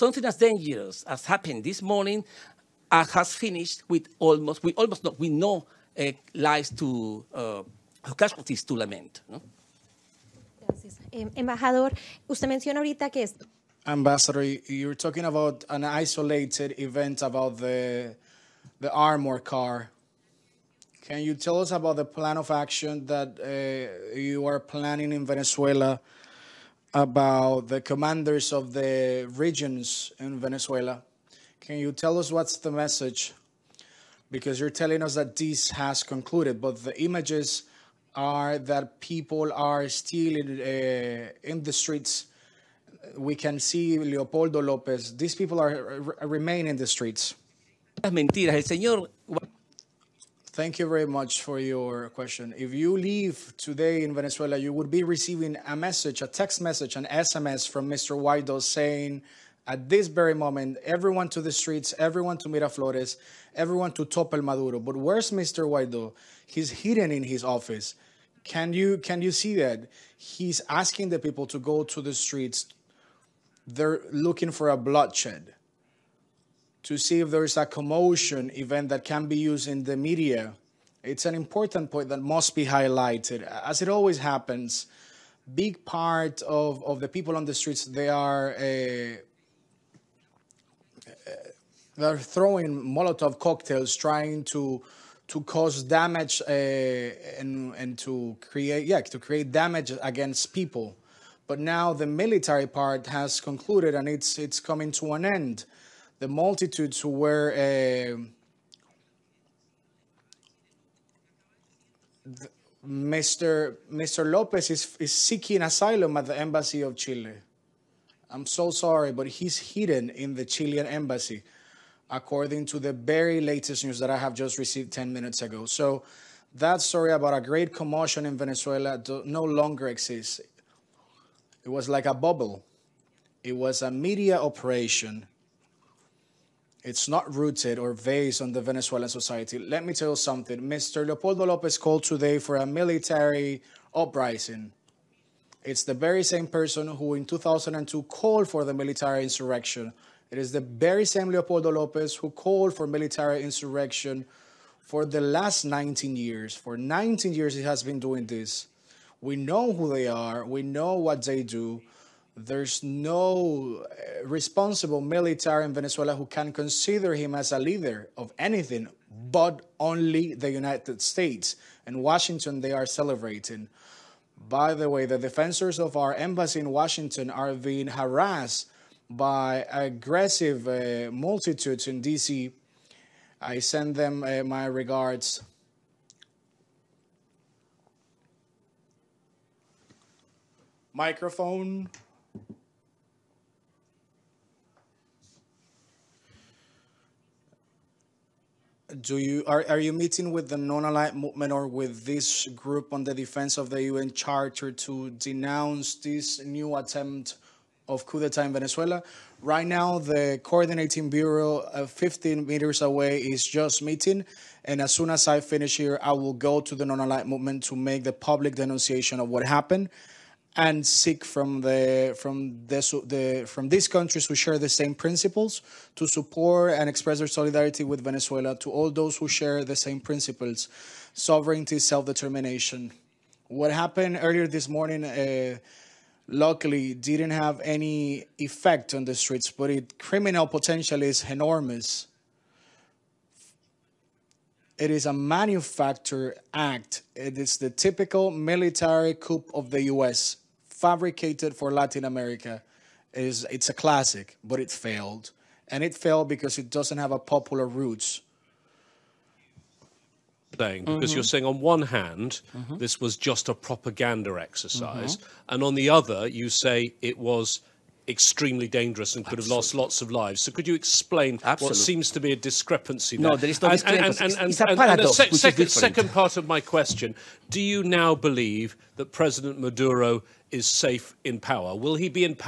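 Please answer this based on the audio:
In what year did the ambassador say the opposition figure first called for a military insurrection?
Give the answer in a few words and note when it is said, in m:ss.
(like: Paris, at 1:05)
2002, at 2:27.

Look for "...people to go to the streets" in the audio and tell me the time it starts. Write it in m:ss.
1:11.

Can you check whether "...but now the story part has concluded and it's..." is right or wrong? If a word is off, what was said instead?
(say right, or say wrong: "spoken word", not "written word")
wrong: "military", not "story".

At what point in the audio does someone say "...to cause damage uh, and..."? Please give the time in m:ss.
1:35.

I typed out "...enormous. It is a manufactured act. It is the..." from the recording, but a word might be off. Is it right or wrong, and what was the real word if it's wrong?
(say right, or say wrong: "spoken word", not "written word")
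right.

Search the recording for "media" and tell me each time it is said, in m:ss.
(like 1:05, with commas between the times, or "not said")
1:19, 2:13.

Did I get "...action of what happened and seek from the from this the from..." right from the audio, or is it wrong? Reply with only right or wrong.
wrong.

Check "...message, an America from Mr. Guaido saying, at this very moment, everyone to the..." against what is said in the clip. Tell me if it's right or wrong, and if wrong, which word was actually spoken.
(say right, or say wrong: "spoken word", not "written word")
wrong: "SMS", not "America".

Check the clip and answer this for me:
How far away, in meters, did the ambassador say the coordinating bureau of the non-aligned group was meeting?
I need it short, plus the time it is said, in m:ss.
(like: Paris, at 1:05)
15 meters, at 3:31.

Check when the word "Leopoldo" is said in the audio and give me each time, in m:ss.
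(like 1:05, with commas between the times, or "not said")
0:43, 2:21, 2:31.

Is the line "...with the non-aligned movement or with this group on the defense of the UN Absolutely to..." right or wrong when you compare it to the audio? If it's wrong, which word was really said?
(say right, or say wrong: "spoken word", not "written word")
wrong: "Charter", not "Absolutely".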